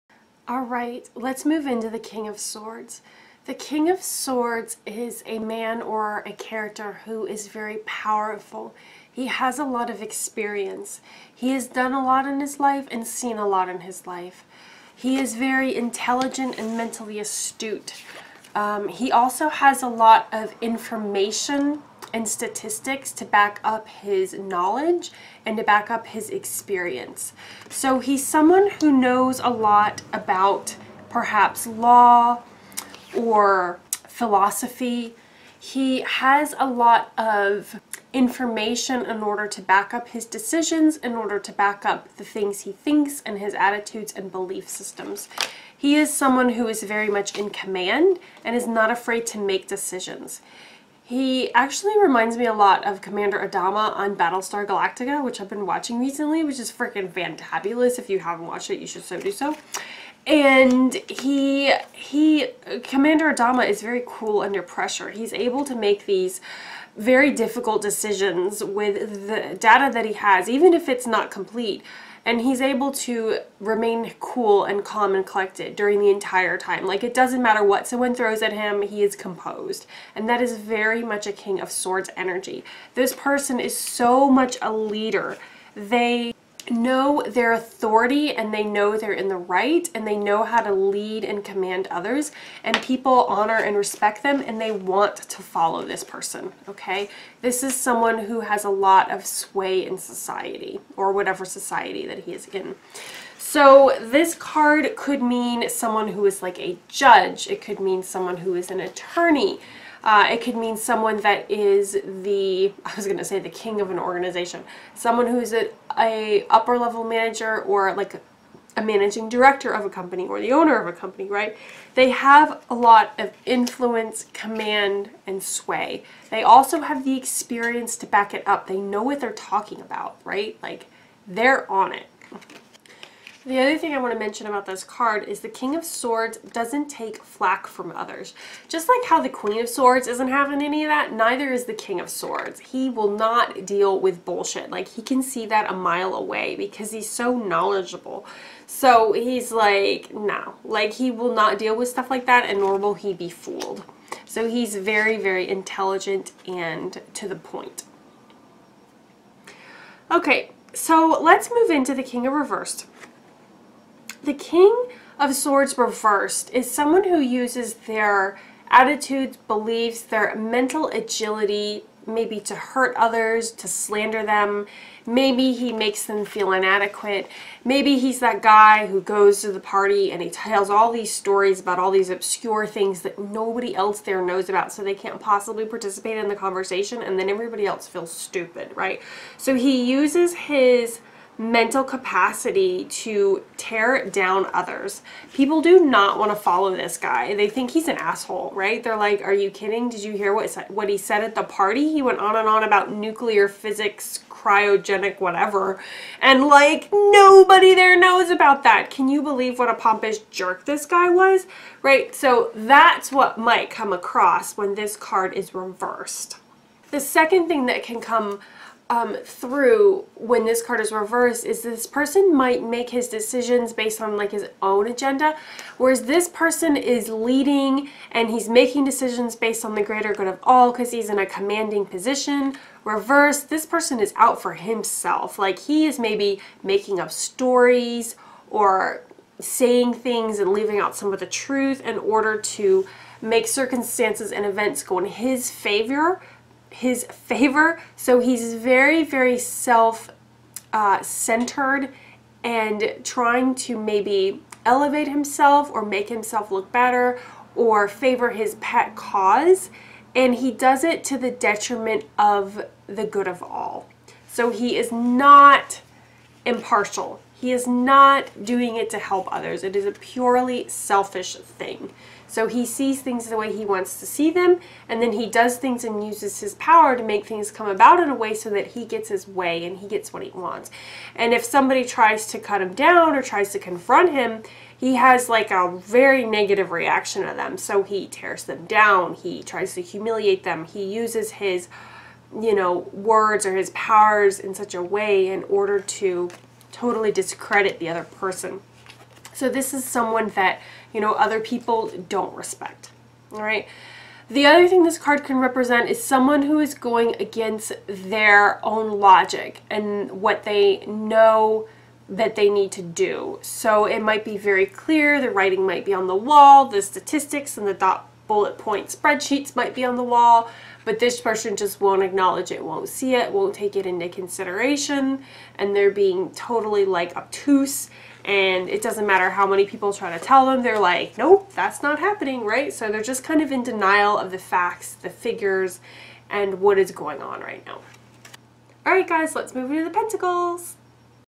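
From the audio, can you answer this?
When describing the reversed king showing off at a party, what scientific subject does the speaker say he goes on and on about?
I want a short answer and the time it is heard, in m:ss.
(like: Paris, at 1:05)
nuclear physics, at 3:22.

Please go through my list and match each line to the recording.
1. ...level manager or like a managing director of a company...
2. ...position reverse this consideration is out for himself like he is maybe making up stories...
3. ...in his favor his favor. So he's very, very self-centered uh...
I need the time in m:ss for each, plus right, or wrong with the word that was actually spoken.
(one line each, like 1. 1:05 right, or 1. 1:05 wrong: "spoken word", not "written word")
1. 1:56 right
2. 3:51 wrong: "person", not "consideration"
3. 4:04 right.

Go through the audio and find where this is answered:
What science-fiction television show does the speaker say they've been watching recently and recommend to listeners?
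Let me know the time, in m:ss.
0:54.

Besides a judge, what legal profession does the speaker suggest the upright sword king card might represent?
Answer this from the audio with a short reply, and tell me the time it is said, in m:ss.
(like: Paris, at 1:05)
attorney, at 1:48.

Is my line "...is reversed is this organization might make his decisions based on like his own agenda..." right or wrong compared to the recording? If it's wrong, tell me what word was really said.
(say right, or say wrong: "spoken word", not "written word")
wrong: "person", not "organization".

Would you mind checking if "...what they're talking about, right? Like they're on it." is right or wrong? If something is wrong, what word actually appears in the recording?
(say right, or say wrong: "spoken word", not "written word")
right.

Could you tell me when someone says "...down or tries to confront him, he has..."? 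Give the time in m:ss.
4:42.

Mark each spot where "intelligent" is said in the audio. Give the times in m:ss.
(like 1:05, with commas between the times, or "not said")
0:15, 2:35.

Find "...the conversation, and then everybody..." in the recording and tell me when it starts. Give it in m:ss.
3:06.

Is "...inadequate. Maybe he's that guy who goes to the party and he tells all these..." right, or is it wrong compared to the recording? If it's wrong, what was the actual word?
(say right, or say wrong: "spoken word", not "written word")
right.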